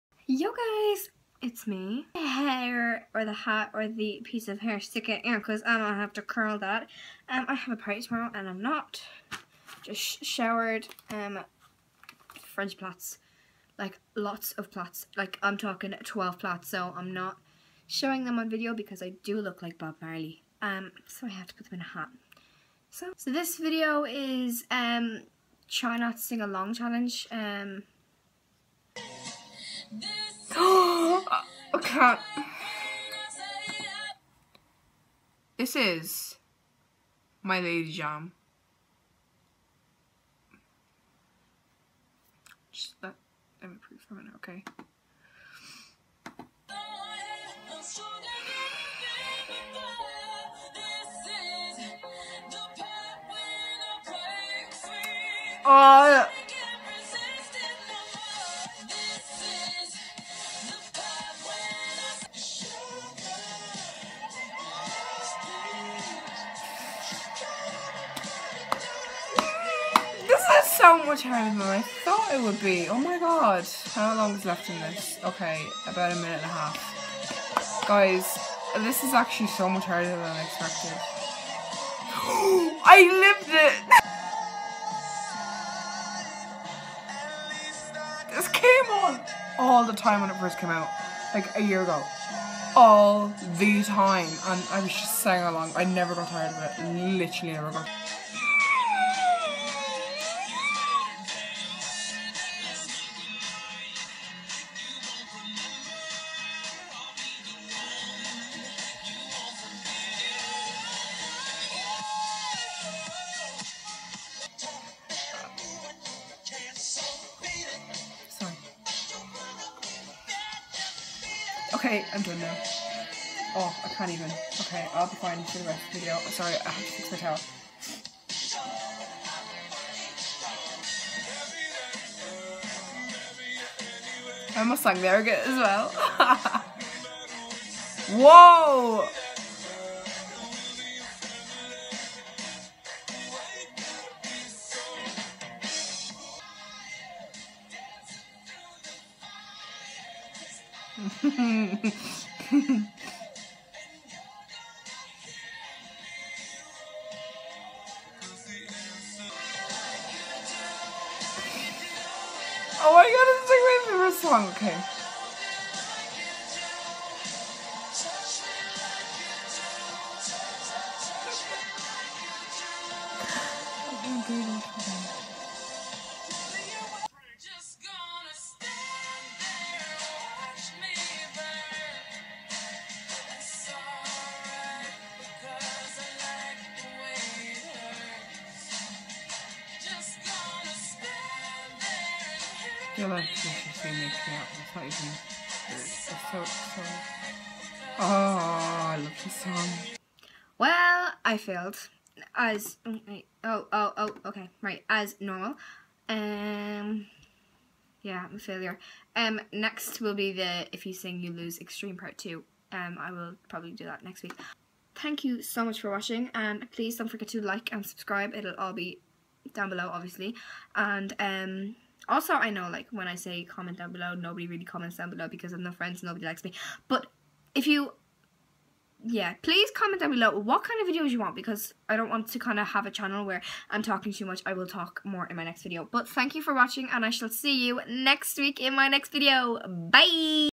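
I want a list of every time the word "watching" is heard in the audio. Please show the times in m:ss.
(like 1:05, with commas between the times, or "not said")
3:35, 3:56.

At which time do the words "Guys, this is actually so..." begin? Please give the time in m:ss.
1:17.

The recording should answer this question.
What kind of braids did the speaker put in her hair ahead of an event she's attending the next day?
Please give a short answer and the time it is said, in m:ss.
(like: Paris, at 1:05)
French plaits, at 0:12.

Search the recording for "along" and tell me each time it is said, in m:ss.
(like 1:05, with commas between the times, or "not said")
0:26, 1:35.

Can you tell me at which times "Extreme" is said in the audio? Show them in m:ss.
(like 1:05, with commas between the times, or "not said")
3:31.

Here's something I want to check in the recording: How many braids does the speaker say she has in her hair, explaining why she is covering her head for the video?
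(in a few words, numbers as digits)
12.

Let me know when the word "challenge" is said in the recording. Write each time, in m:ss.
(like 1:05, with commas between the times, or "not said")
0:26.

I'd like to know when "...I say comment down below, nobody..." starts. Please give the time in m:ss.
3:43.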